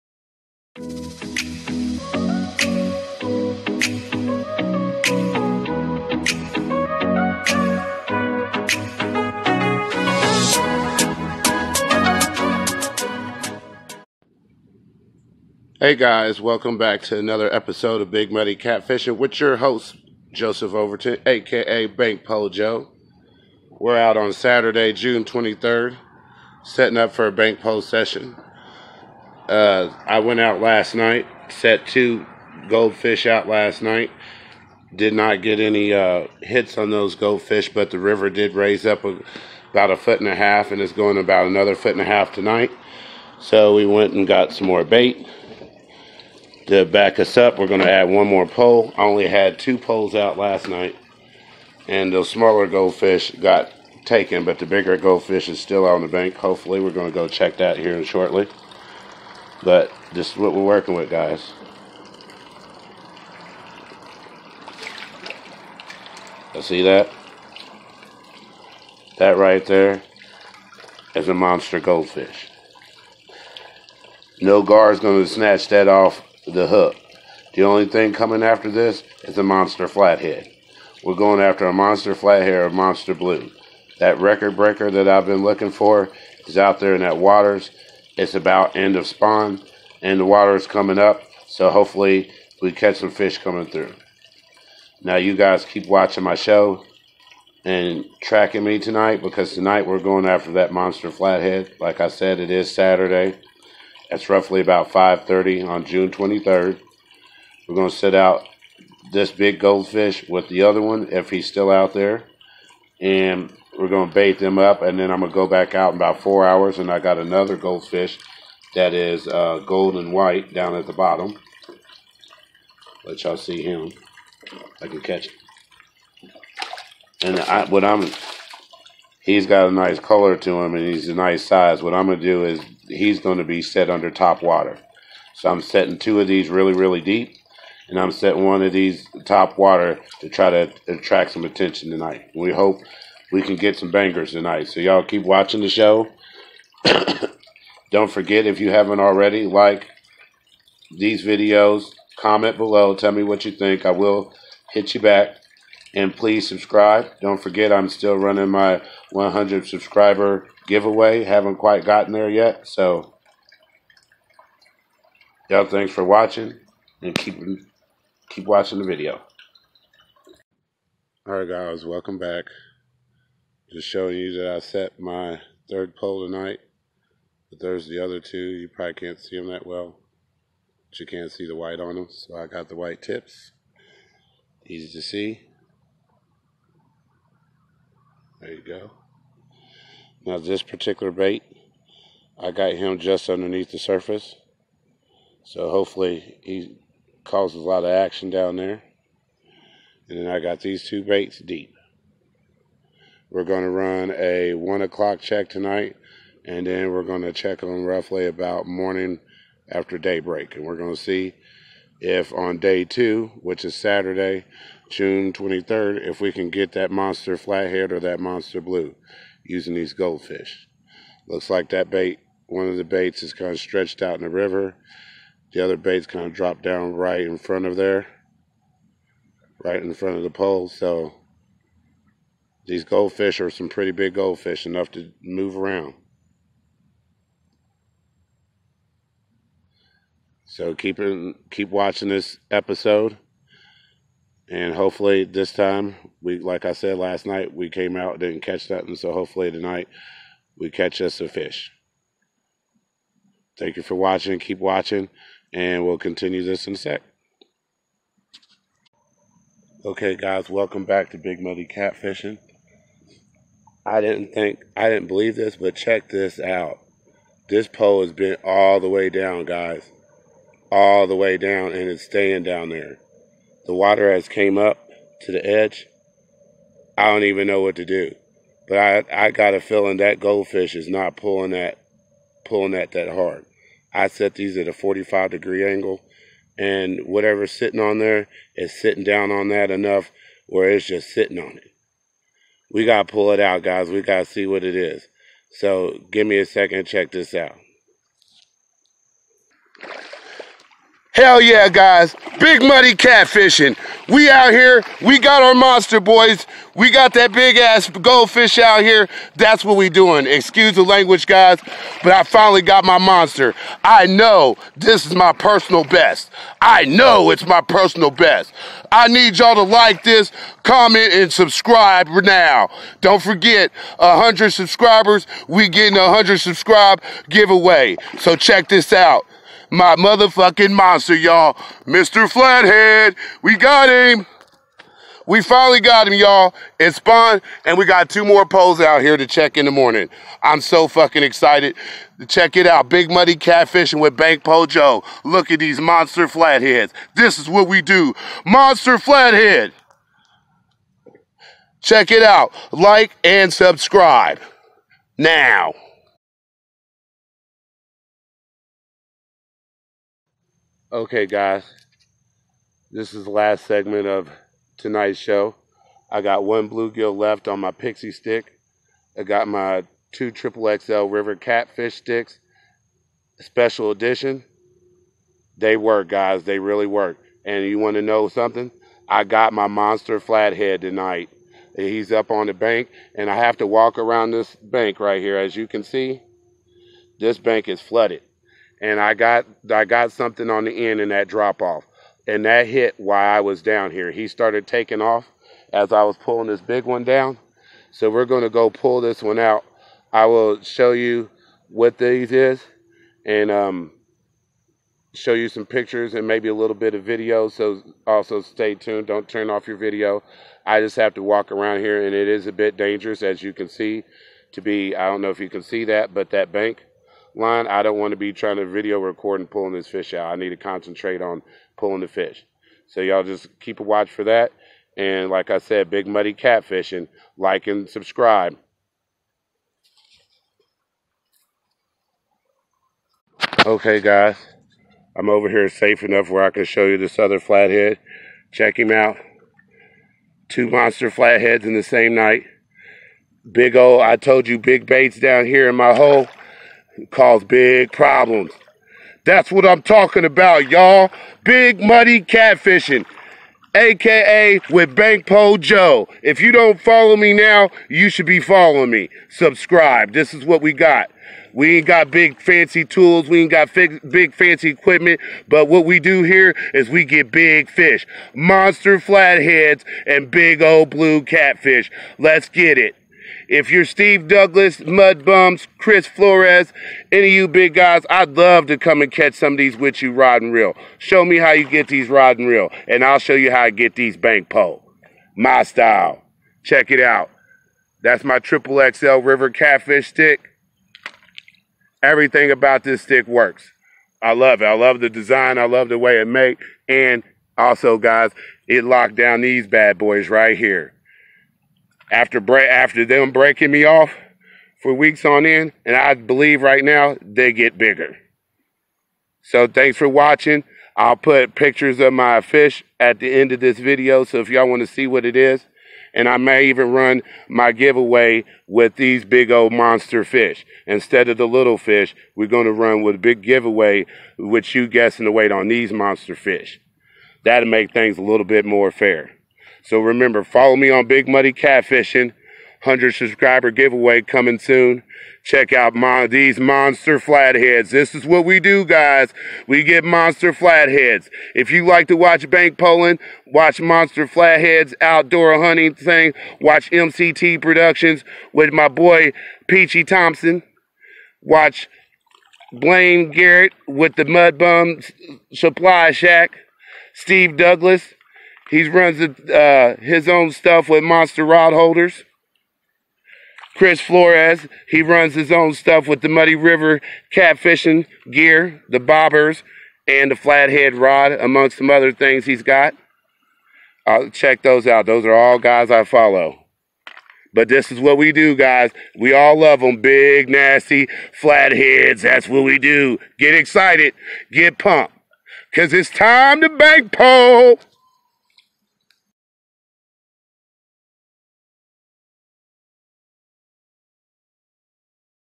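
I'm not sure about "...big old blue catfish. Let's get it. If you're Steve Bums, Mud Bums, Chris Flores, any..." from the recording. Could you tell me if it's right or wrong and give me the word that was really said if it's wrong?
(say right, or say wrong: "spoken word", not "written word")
wrong: "Douglas", not "Bums".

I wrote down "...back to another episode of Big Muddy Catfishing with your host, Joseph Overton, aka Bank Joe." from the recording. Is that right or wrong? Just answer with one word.
right.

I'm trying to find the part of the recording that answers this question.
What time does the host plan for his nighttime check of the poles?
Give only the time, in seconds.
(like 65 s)
204 s.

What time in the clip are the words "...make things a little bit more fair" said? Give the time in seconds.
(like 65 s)
527 s.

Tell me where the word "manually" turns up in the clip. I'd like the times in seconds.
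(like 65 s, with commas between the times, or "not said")
not said.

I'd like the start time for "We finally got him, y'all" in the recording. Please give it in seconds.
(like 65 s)
335 s.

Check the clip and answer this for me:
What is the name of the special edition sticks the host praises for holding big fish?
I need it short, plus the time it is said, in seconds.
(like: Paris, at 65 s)
Triple XL River Catfish stick, at 488 s.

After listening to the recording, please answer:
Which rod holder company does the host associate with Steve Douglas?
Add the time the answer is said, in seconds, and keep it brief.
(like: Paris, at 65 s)
Monster Rod Holders, at 561 s.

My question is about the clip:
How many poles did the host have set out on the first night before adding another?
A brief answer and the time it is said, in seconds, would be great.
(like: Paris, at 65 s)
2, at 48 s.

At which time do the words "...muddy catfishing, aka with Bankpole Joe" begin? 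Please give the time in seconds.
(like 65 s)
451 s.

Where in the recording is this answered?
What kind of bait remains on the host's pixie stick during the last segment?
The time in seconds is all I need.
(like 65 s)
366 s.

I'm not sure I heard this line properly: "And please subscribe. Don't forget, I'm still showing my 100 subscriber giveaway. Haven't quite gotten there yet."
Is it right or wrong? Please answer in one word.
wrong.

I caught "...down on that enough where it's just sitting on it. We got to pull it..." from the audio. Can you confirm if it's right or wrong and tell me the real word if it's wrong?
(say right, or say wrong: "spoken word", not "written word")
right.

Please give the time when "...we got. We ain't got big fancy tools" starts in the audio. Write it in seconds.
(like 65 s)
460 s.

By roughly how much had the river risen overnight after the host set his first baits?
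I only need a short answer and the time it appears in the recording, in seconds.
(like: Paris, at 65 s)
a foot and a half, at 39 s.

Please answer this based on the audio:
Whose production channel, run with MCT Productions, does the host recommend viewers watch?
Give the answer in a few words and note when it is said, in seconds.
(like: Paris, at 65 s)
Peachy Thompson, at 549 s.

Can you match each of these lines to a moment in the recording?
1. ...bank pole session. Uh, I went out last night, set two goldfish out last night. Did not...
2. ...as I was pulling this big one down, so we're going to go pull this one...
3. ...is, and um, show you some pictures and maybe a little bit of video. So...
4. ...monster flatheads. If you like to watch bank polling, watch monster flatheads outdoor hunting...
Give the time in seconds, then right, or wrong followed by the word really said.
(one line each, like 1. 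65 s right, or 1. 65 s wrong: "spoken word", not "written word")
1. 27 s right
2. 395 s right
3. 402 s right
4. 540 s right.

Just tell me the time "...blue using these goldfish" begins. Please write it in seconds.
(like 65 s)
218 s.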